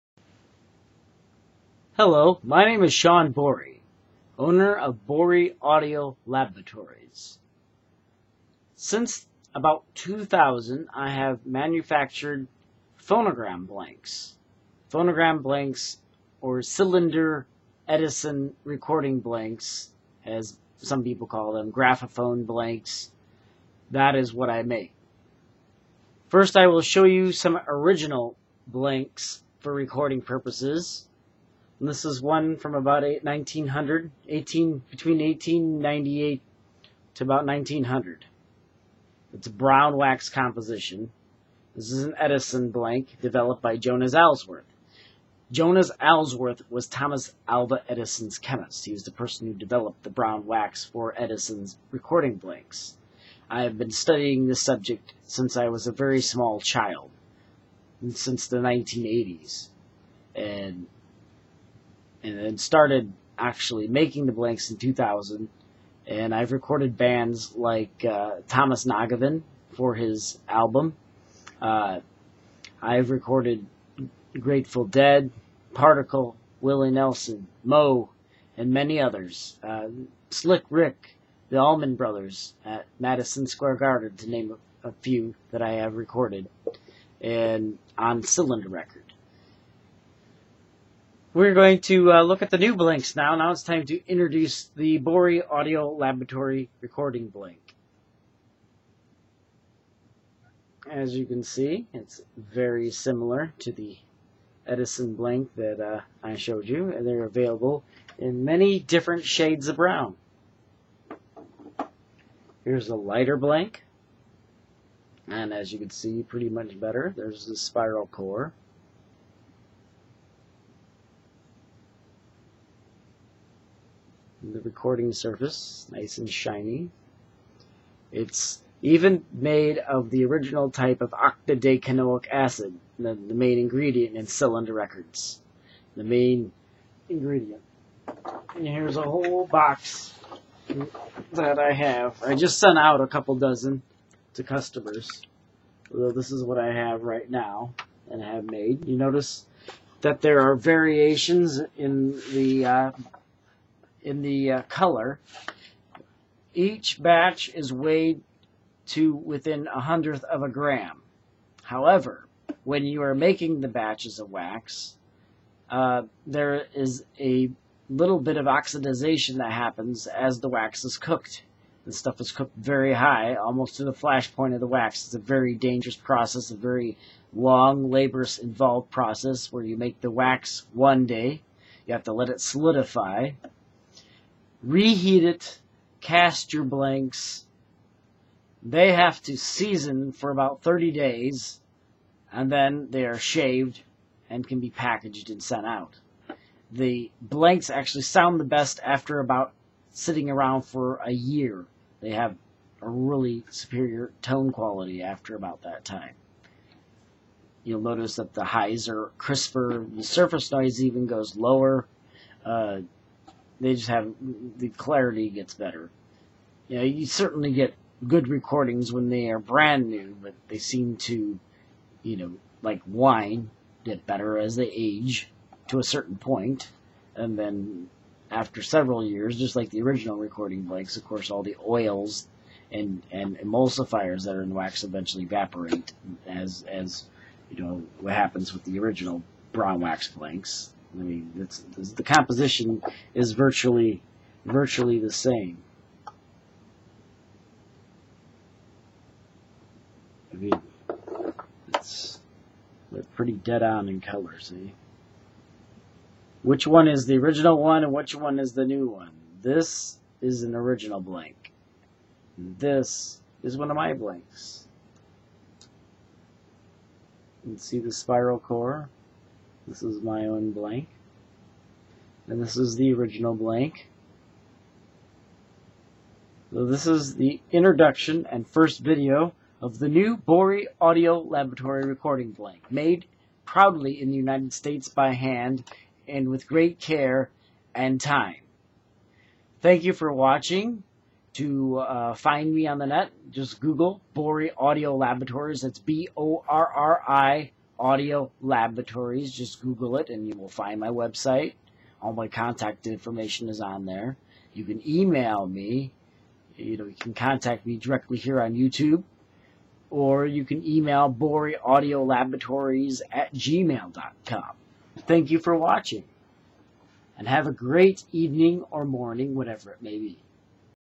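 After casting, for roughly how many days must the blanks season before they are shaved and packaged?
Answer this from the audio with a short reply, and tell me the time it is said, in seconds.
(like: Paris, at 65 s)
30 days, at 190 s.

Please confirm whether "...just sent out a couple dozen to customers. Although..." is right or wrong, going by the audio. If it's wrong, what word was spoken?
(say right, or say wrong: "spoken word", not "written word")
right.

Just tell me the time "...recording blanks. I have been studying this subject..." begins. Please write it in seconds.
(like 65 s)
51 s.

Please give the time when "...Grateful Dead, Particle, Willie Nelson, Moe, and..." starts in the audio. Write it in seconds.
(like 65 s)
74 s.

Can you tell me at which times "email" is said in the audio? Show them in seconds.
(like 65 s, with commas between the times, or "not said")
304 s, 310 s.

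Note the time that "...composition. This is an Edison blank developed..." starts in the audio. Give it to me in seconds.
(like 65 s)
40 s.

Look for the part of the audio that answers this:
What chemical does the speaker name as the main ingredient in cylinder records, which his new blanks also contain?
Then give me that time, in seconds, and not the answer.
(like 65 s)
131 s.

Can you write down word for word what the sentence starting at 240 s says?
I mean, the composition is virtually virtually the same.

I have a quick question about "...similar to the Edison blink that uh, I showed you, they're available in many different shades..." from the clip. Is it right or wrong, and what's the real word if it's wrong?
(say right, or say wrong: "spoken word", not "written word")
right.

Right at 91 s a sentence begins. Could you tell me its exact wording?
We're going to uh, look at the new blinks now.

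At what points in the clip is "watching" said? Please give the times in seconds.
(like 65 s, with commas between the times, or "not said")
290 s, 315 s.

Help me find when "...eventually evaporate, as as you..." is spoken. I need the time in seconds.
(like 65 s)
234 s.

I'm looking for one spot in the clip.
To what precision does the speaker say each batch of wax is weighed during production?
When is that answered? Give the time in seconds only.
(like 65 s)
159 s.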